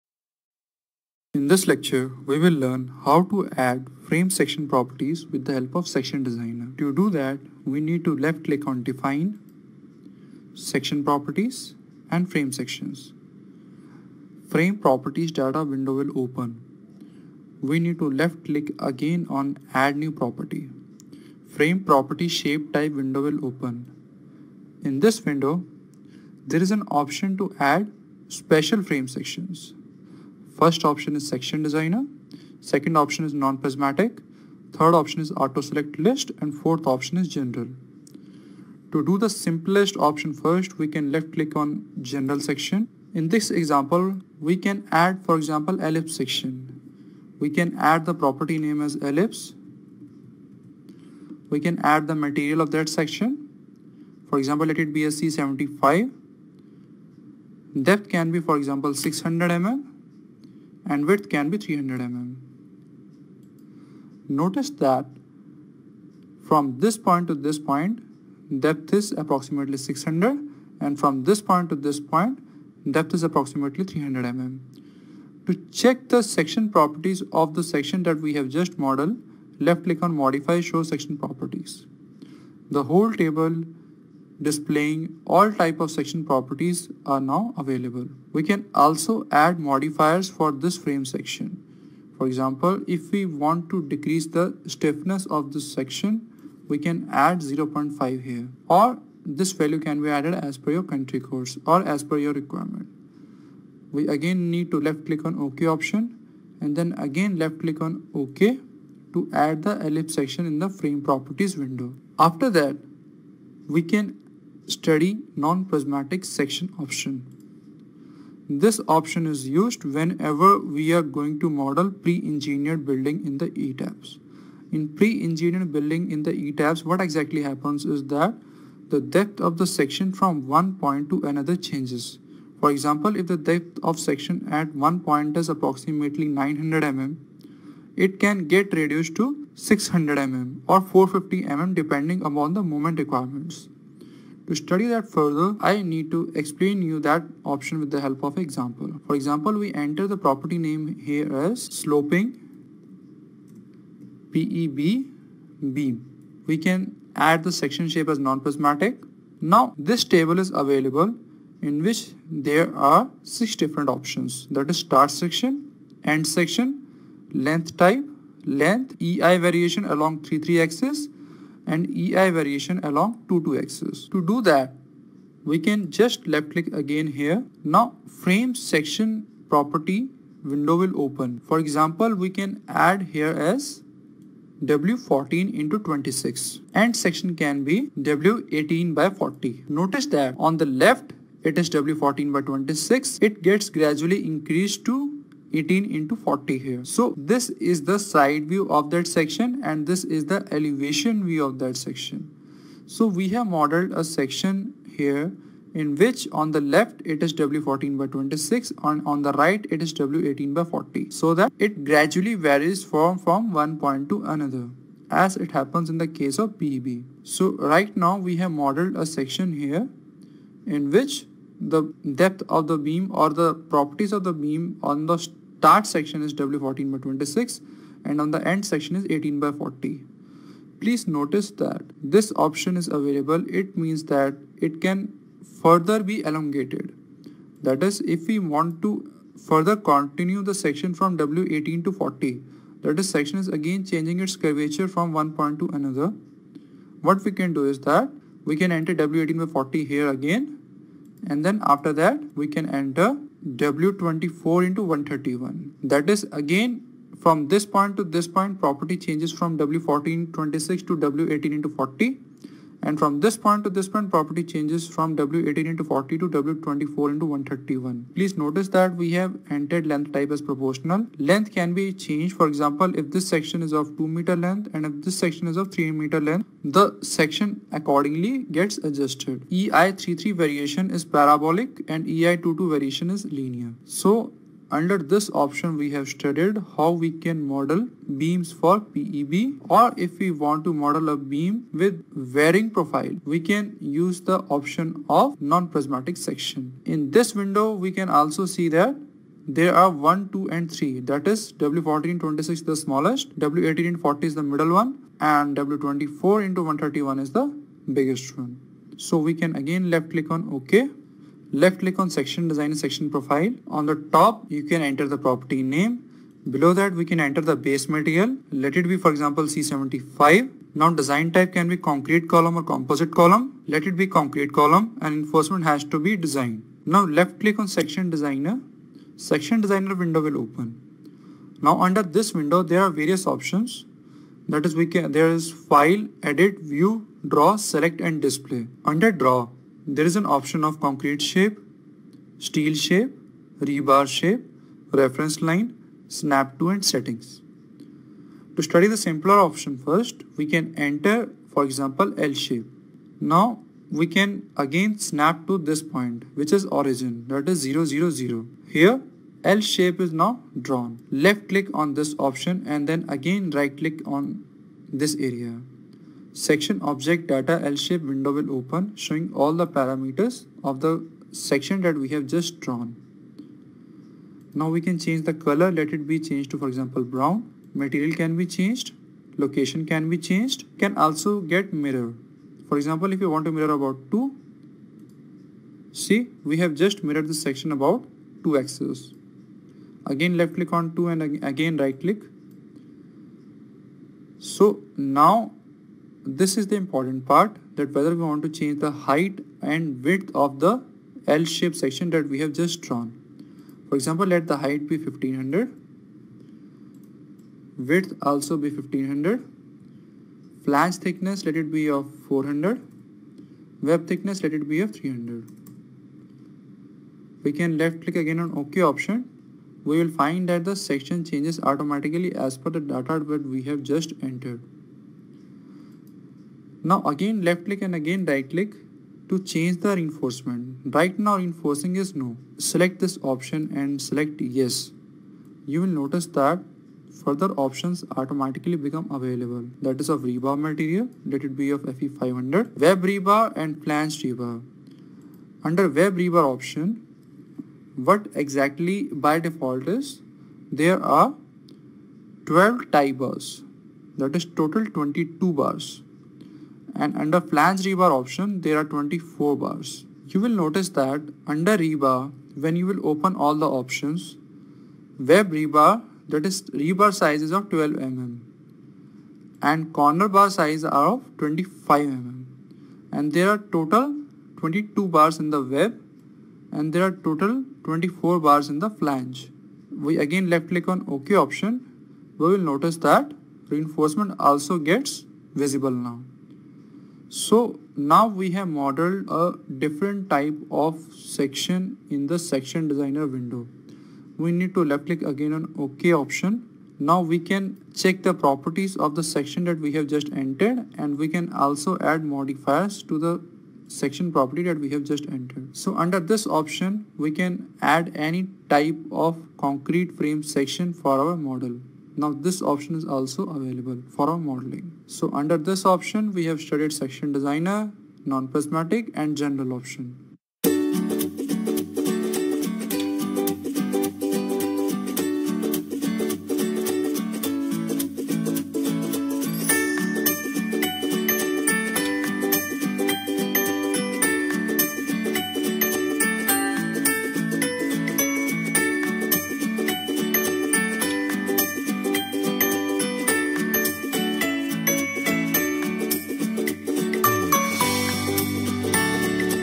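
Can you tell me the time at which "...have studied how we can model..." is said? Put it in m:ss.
4:45.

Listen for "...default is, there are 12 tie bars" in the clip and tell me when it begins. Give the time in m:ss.
7:29.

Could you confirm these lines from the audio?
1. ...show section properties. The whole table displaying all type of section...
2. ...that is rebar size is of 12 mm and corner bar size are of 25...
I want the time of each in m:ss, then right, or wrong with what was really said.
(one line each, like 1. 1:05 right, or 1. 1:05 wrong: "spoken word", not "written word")
1. 1:20 right
2. 7:46 right.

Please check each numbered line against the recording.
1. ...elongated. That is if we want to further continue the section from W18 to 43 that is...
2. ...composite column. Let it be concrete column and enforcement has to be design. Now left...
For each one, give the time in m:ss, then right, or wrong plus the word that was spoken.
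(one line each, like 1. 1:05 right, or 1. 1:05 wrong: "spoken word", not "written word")
1. 3:56 wrong: "40", not "43"
2. 5:22 right.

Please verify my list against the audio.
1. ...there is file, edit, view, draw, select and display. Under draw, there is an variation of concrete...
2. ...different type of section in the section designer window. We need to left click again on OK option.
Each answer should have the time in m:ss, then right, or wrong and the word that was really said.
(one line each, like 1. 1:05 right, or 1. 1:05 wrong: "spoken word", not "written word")
1. 5:35 wrong: "option", not "variation"
2. 8:09 right.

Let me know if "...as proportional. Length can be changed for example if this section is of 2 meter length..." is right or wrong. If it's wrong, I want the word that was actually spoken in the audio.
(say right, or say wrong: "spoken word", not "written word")
right.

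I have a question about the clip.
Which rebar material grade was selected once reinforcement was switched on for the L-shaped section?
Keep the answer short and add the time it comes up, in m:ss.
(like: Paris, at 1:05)
FE500, at 7:21.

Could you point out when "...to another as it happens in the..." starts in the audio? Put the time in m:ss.
3:34.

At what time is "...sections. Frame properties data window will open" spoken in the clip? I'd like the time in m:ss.
0:12.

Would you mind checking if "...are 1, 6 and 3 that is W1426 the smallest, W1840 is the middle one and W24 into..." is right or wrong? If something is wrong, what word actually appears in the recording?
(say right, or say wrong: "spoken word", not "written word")
wrong: "2", not "6".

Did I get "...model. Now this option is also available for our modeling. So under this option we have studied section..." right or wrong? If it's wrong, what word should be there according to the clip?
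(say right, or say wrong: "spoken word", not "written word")
right.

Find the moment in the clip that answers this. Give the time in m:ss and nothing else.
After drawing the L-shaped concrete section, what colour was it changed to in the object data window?
6:17.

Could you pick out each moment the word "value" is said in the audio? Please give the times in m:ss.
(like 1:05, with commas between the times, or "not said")
1:39.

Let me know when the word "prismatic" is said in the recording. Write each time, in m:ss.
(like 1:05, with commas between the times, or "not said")
0:33, 1:55, 2:38, 4:55, 8:38.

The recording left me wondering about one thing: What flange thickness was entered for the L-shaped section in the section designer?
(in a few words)
400.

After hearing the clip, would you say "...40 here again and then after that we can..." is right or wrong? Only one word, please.
right.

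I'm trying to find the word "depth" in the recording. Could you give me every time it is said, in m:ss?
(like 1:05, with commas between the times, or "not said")
0:57, 1:08, 1:12, 2:09, 2:13, 3:42.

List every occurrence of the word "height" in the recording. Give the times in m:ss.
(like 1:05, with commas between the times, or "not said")
6:38, 6:44.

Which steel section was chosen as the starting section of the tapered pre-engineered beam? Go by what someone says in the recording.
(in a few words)
W14x26.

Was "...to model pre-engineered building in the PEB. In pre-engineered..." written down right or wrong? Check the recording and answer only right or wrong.
wrong.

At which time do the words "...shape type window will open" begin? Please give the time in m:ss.
0:22.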